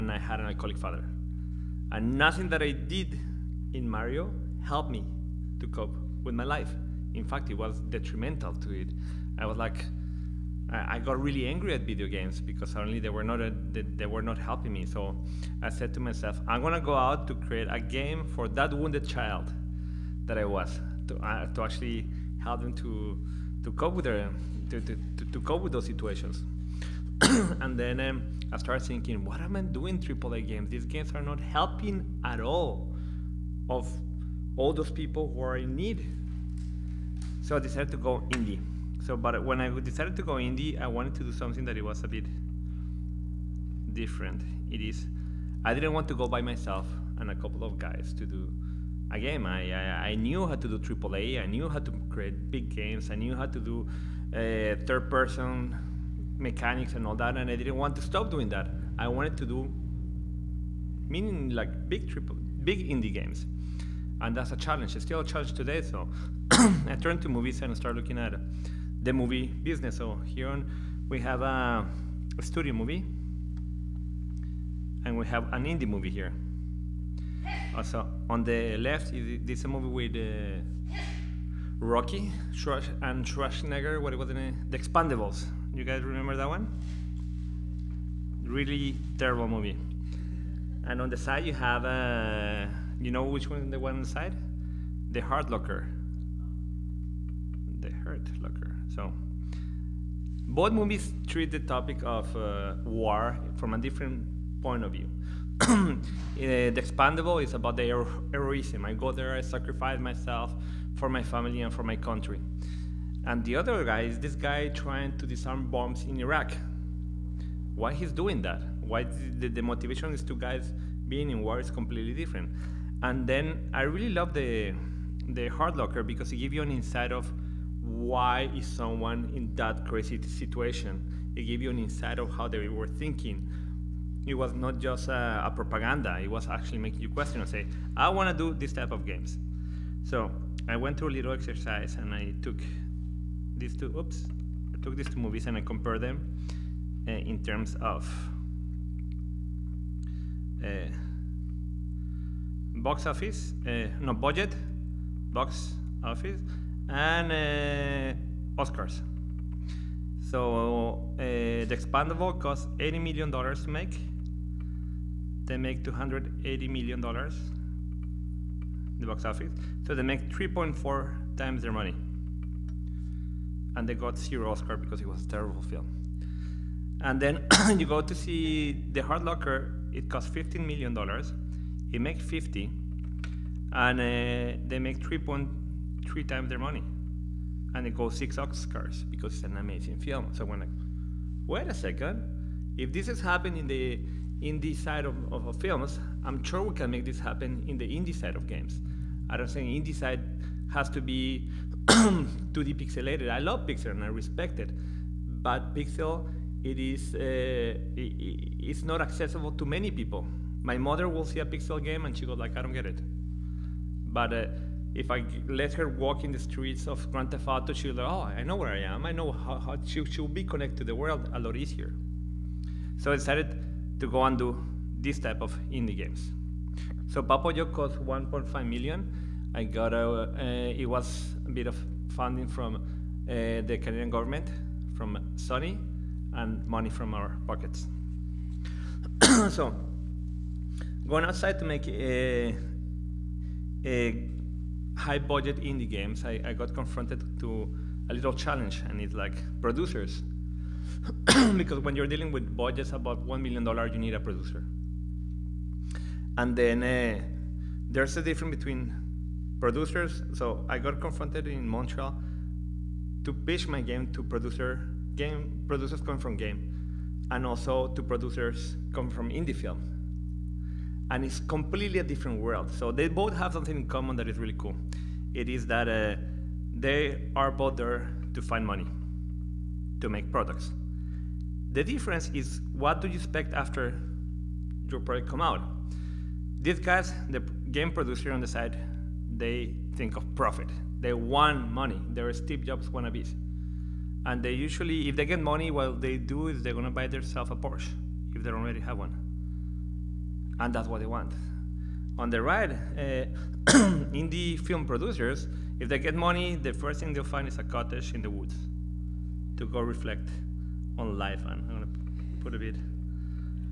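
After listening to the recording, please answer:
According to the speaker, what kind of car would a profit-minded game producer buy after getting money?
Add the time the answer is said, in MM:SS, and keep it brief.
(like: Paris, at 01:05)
Porsche, at 04:57.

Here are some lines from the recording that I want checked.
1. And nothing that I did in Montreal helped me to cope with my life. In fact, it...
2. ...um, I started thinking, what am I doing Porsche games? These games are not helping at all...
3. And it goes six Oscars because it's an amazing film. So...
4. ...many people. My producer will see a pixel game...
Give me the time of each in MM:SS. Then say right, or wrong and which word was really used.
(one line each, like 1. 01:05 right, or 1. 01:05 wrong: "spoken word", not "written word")
1. 00:01 wrong: "Mario", not "Montreal"
2. 00:27 wrong: "AAA", not "Porsche"
3. 03:07 right
4. 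03:29 wrong: "mother", not "producer".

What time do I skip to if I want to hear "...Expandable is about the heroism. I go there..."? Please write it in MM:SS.
01:46.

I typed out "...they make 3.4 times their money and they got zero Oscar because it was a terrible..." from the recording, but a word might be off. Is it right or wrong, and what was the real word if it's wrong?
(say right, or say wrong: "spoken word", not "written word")
right.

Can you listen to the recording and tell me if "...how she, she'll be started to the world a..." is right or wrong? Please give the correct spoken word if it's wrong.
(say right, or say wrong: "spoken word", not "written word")
wrong: "connected", not "started".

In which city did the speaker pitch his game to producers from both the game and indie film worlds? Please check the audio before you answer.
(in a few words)
Montreal.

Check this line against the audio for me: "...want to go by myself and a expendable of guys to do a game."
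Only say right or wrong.
wrong.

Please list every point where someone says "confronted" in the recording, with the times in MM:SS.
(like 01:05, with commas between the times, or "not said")
04:06, 04:20.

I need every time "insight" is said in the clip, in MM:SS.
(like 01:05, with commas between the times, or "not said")
02:06, 02:11.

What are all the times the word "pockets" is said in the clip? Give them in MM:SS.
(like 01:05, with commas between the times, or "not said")
03:57.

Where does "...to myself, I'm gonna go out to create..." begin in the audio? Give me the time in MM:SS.
00:15.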